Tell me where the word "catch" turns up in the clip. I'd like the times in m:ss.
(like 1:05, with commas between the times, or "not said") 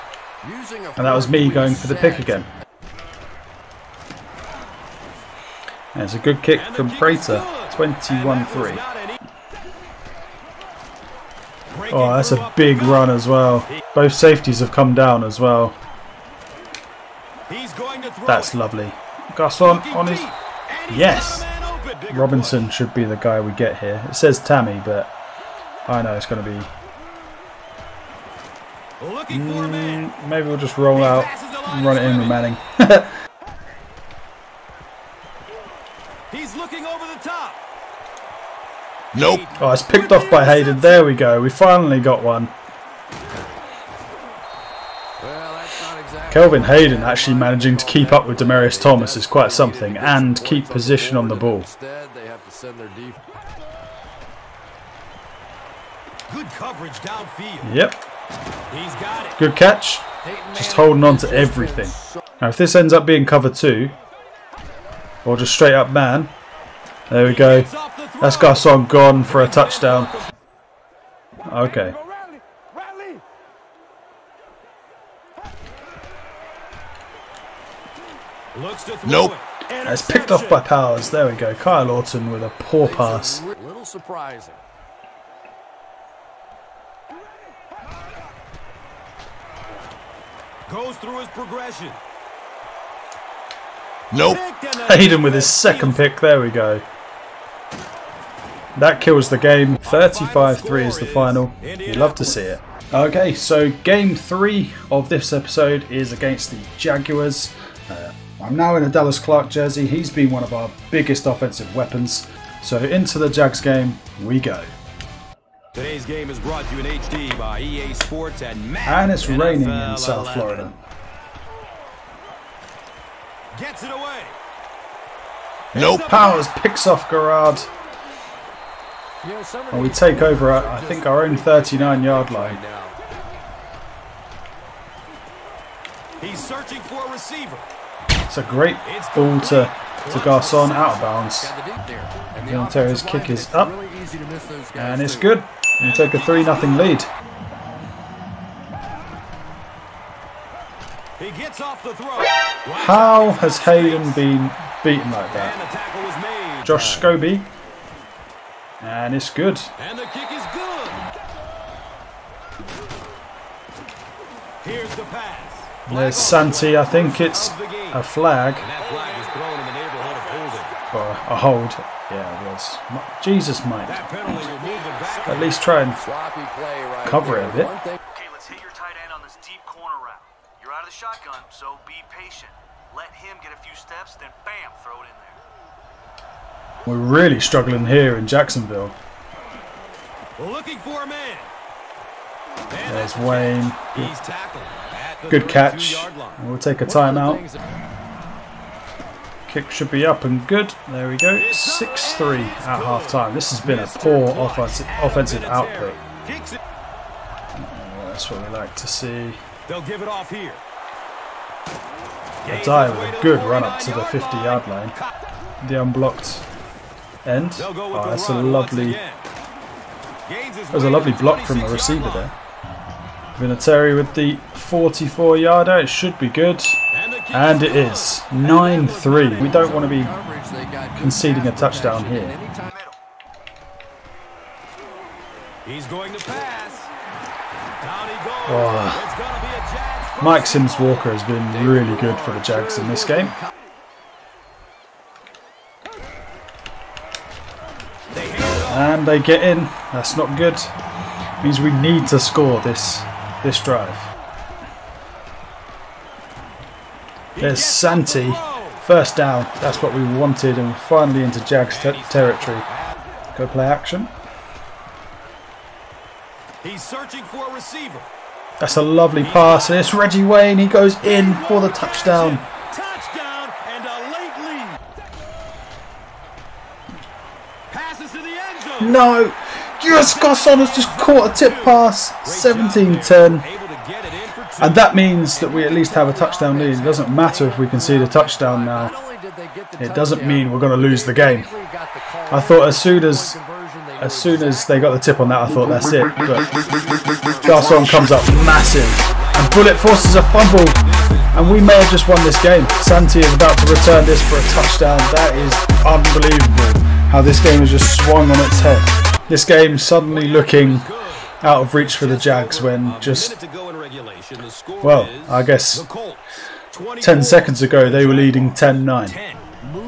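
0:59, 3:15.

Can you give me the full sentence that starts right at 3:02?
Let him get a few steps, then bam, throw it in there.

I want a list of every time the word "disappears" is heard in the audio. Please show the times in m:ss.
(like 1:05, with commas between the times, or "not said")
not said.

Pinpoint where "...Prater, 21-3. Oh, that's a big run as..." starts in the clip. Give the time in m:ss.
0:06.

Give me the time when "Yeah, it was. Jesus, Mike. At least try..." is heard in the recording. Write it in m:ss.
2:52.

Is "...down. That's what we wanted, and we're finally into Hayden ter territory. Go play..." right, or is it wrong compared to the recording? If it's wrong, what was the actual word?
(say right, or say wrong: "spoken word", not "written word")
wrong: "Jags", not "Hayden".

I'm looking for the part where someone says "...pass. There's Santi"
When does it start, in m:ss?
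2:45.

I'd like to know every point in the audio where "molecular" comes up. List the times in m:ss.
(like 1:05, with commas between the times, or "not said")
not said.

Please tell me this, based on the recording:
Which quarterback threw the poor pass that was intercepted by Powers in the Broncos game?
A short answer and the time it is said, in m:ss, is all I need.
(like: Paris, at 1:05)
Kyle Orton, at 1:21.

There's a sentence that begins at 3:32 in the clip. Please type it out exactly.
Addai with a good run up to the 50 yard line.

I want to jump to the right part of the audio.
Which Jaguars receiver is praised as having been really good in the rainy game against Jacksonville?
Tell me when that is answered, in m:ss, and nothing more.
4:00.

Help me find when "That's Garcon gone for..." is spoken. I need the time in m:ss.
1:08.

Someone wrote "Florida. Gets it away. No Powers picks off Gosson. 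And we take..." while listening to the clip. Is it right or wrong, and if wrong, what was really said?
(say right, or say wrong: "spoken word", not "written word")
wrong: "Garrard", not "Gosson".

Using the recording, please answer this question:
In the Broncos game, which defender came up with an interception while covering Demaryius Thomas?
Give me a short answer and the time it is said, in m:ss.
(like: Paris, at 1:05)
Kelvin Hayden, at 0:46.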